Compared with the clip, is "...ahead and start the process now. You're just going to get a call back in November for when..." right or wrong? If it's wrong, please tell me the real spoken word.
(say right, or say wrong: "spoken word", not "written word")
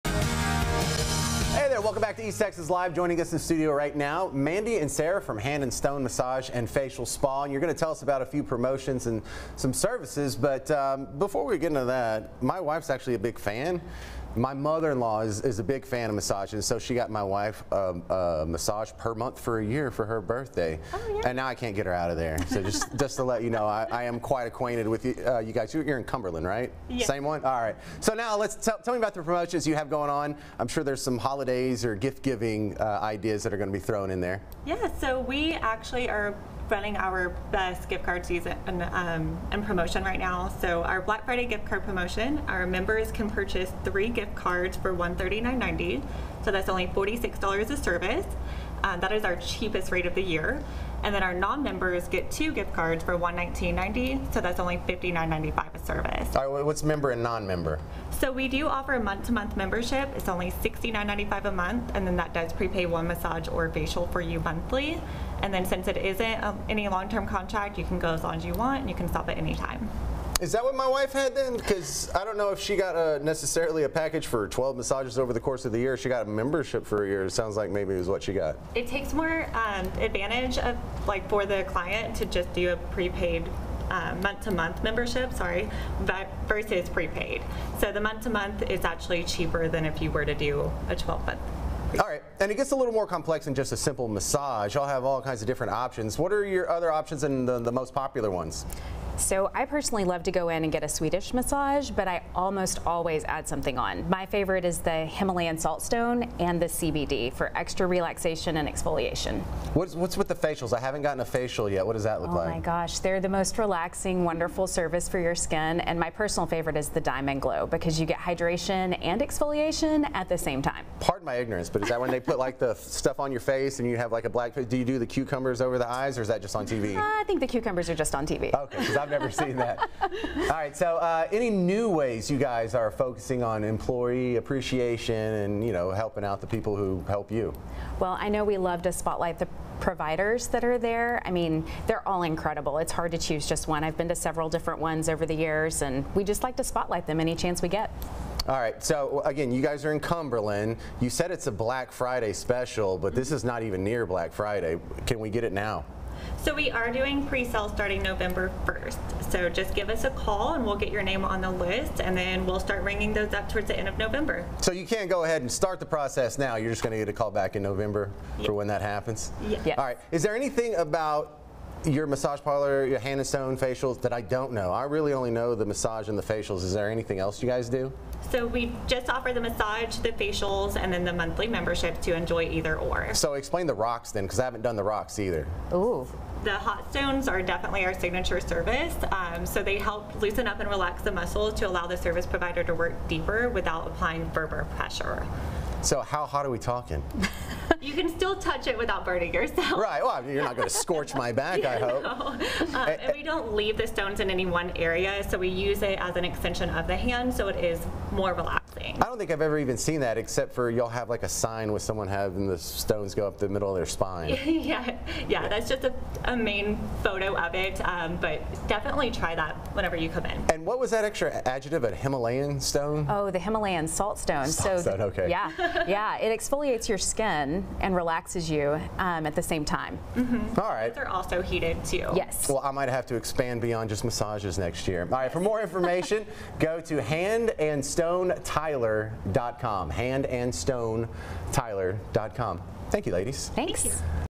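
right.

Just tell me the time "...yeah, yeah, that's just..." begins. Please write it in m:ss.
3:34.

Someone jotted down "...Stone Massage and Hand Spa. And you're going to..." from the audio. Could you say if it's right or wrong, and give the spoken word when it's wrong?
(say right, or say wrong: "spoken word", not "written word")
wrong: "Facial", not "Hand".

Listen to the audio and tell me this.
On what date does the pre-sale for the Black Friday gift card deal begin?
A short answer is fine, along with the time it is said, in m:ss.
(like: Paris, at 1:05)
November 1st, at 2:38.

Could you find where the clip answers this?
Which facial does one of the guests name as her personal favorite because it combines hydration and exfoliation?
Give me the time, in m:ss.
1:57.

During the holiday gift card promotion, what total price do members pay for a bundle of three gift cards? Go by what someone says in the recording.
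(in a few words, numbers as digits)
$139.90.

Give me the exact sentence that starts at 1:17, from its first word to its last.
It sounds like maybe it was what she got.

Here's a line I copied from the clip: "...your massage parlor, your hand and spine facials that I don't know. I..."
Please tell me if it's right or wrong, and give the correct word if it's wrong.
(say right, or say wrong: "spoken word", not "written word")
wrong: "stone", not "spine".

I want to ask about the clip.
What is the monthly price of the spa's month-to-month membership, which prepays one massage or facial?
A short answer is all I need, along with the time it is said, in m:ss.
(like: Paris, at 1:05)
$69.95, at 1:00.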